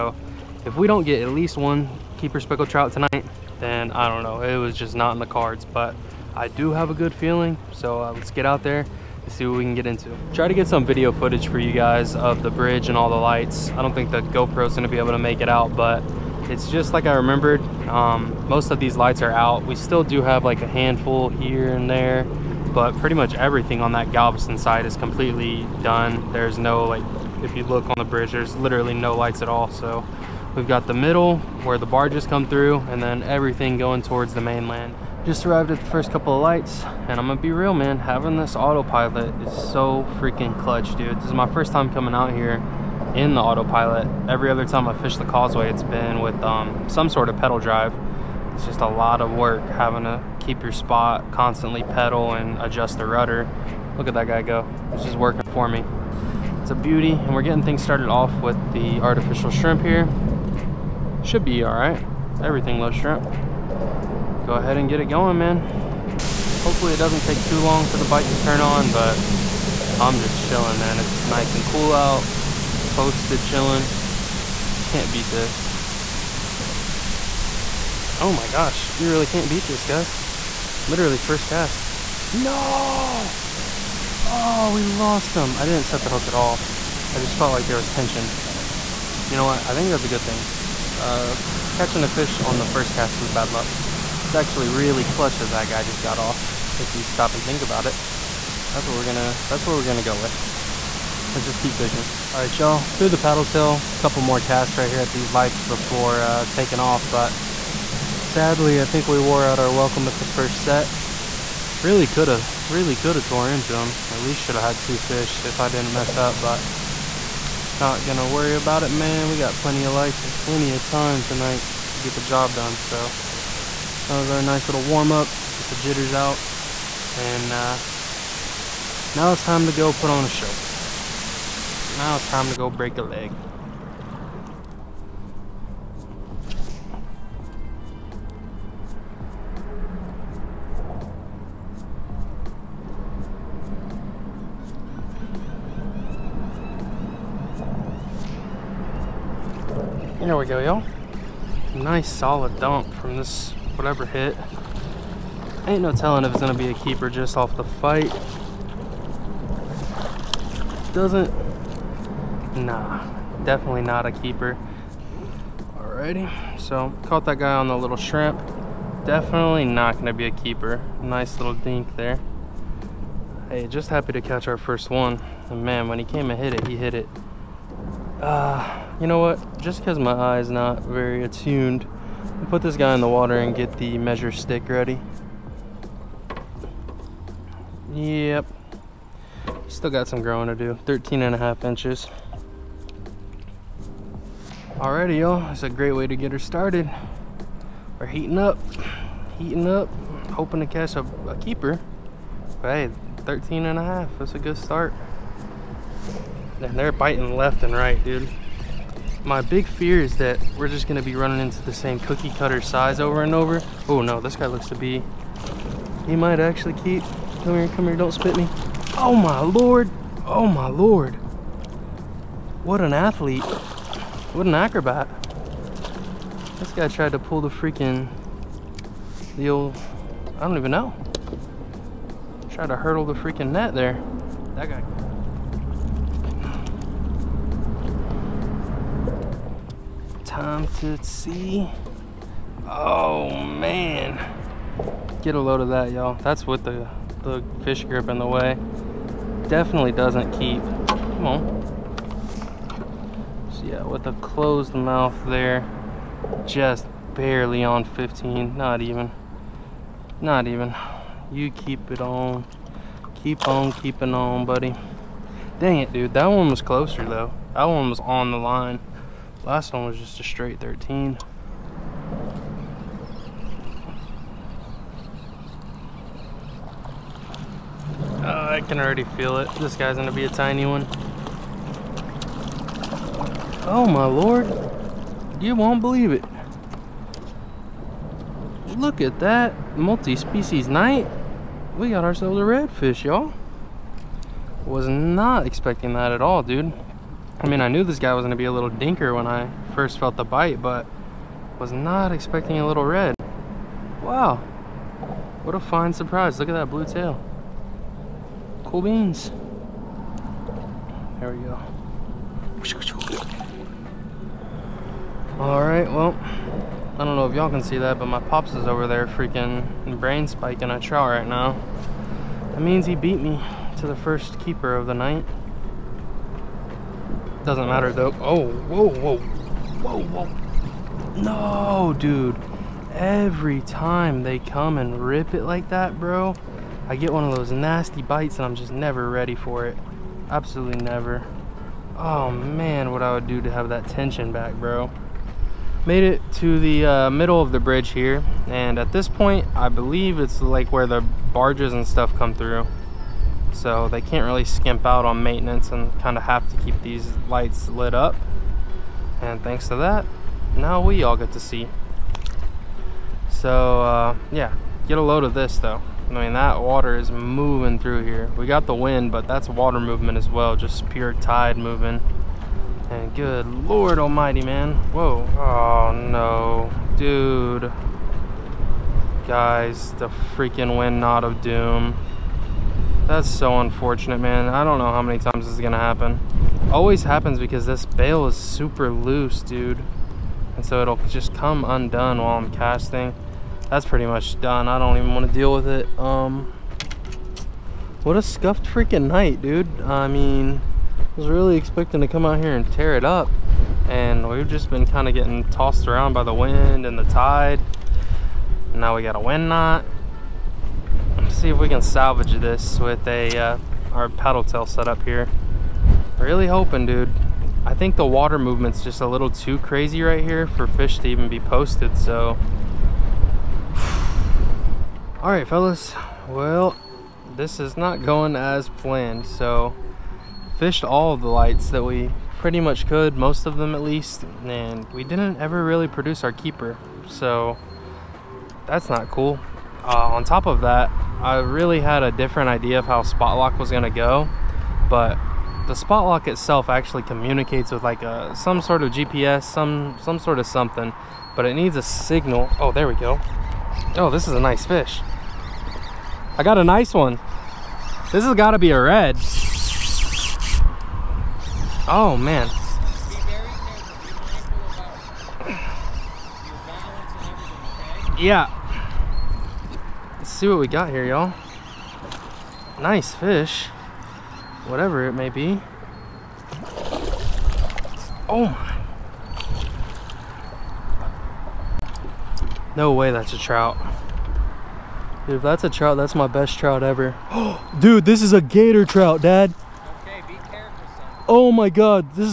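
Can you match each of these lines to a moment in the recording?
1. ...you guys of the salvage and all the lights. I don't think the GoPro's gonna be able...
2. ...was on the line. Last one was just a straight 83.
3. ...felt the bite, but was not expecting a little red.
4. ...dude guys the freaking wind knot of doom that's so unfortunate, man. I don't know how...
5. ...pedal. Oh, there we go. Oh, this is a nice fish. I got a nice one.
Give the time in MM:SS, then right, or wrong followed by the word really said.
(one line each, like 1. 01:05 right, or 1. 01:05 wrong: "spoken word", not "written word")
1. 00:11 wrong: "bridge", not "salvage"
2. 04:27 wrong: "13", not "83"
3. 04:59 right
4. 06:16 right
5. 07:31 wrong: "signal", not "pedal".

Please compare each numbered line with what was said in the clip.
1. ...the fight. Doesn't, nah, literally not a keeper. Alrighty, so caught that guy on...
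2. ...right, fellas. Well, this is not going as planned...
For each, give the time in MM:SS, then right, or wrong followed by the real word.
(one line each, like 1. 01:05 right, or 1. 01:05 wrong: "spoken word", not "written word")
1. 02:37 wrong: "definitely", not "literally"
2. 07:05 right.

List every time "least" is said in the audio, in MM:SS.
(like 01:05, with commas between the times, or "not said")
00:01, 01:54, 07:13.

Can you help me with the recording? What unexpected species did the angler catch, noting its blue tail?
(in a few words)
redfish.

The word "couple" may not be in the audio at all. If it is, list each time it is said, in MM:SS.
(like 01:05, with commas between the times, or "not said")
00:36, 01:44.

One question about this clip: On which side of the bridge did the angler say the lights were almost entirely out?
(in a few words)
Galveston.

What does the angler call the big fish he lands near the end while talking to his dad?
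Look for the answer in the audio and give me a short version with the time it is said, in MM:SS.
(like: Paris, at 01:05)
gator trout, at 08:08.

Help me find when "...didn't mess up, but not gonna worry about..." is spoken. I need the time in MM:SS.
01:55.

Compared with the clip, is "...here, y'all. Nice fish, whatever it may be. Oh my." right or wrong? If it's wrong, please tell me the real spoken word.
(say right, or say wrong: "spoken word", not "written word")
right.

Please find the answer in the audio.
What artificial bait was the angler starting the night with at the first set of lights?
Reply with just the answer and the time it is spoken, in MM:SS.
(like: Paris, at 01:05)
artificial shrimp, at 00:59.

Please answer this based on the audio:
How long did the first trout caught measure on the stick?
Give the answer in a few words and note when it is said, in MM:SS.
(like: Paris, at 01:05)
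13.5 inches, at 03:10.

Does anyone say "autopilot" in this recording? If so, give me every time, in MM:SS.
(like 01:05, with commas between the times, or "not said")
00:38, 00:43.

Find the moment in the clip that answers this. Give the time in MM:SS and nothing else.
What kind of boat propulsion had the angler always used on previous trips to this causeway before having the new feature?
00:47.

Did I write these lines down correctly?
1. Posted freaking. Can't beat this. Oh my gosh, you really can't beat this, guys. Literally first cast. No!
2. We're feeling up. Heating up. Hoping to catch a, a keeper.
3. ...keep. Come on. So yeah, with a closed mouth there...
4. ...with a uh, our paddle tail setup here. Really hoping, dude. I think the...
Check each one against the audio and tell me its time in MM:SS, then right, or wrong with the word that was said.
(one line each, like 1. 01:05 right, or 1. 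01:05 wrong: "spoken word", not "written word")
1. 01:12 wrong: "chilling", not "freaking"
2. 03:17 wrong: "heating", not "feeling"
3. 04:10 right
4. 06:52 right.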